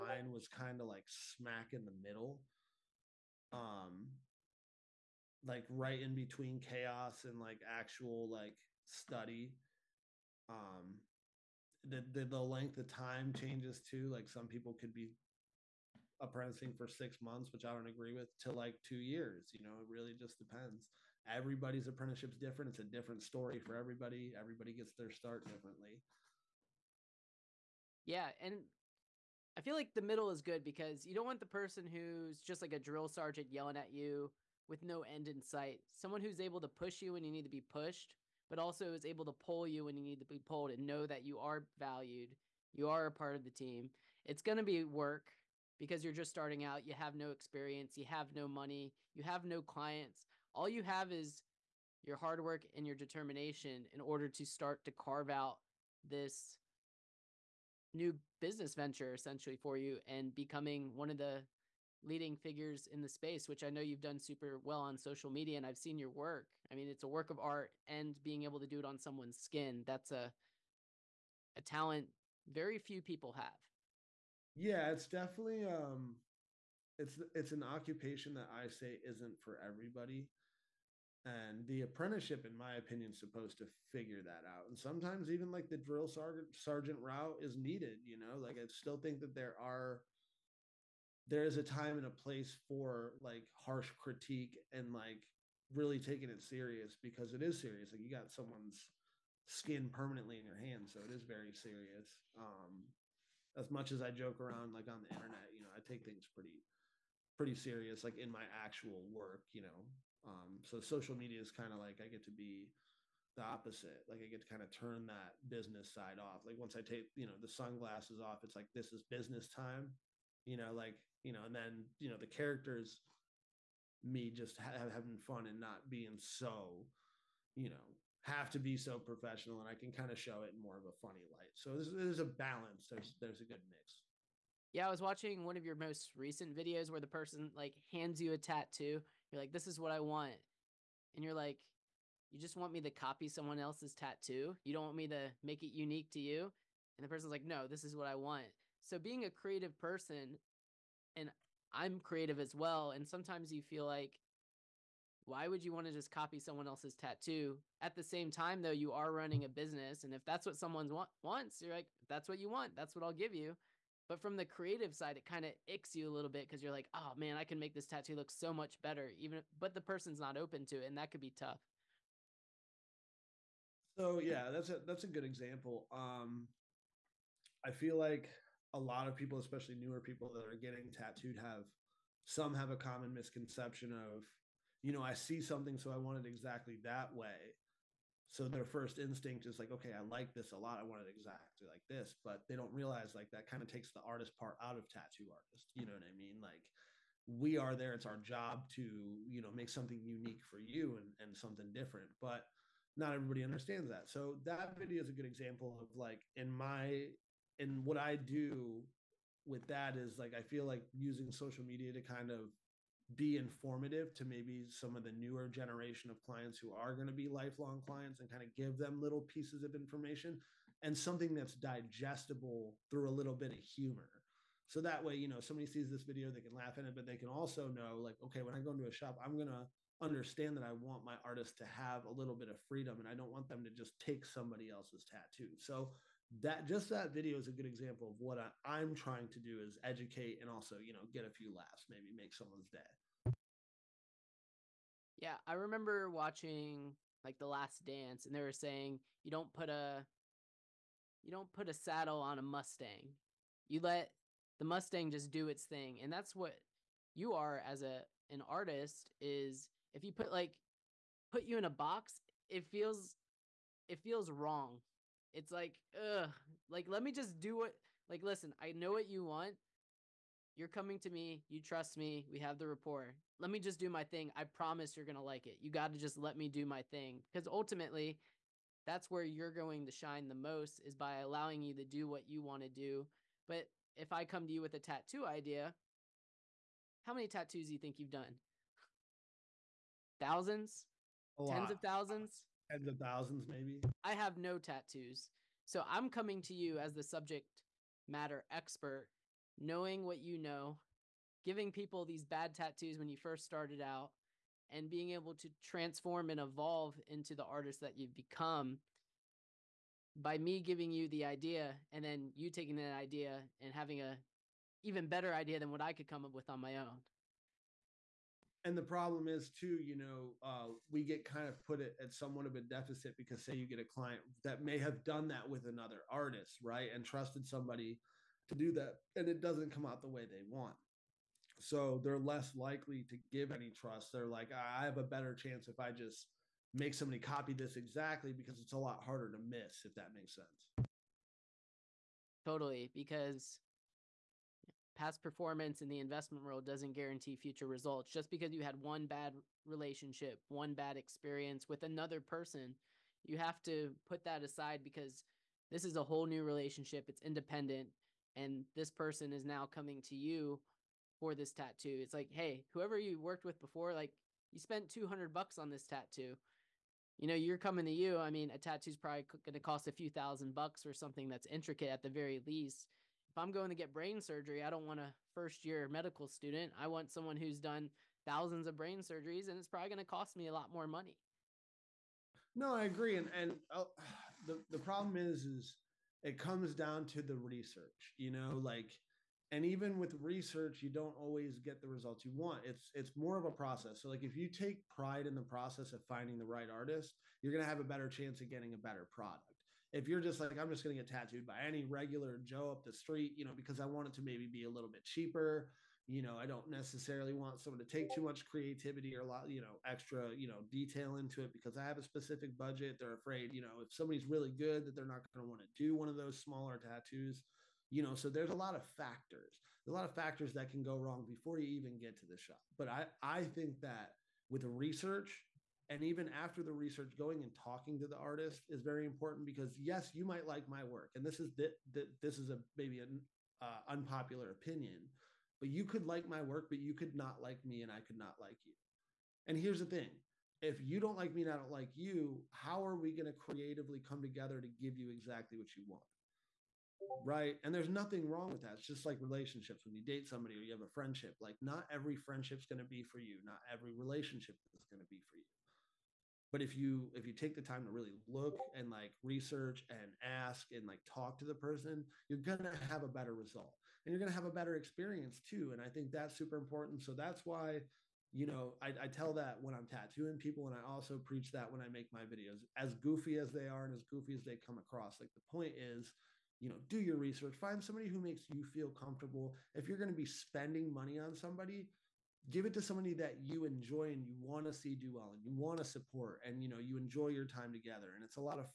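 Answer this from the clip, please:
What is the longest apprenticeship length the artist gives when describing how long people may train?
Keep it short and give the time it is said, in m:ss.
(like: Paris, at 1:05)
2 years, at 0:18.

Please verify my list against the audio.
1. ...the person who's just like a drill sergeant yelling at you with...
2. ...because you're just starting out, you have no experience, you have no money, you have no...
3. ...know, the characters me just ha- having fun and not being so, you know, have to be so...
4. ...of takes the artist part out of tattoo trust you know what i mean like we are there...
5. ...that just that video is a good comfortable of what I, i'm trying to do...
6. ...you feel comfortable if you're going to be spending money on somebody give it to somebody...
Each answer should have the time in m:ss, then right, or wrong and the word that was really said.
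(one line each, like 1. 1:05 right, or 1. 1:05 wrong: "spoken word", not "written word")
1. 0:31 right
2. 0:45 right
3. 2:02 right
4. 3:13 wrong: "artist", not "trust"
5. 3:56 wrong: "example", not "comfortable"
6. 7:58 right.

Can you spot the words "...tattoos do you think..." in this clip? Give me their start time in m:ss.
4:47.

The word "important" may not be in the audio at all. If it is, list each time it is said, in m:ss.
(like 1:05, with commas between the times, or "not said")
7:09, 7:46.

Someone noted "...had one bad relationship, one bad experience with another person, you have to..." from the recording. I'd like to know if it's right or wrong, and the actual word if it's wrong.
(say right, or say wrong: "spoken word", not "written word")
right.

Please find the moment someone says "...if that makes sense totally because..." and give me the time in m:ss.
5:39.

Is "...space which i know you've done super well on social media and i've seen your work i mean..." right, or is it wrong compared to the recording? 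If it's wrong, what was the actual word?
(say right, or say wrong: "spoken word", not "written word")
right.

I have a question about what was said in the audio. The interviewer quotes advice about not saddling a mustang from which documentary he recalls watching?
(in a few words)
The Last Dance.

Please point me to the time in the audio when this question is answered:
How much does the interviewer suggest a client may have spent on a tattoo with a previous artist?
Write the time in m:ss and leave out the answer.
6:04.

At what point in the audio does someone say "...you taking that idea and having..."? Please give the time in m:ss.
5:12.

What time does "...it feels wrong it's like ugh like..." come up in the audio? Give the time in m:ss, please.
4:23.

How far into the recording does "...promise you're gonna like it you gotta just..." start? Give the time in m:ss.
4:34.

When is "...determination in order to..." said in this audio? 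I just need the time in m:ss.
0:52.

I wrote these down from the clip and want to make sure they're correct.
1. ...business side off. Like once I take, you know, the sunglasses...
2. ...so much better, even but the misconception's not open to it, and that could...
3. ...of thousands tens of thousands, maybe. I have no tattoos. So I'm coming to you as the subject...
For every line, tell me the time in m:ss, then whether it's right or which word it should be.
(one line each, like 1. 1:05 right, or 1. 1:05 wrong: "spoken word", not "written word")
1. 1:55 right
2. 2:48 wrong: "person", not "misconception"
3. 4:51 right.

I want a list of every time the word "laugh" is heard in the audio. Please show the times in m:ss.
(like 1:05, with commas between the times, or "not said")
3:46, 4:01.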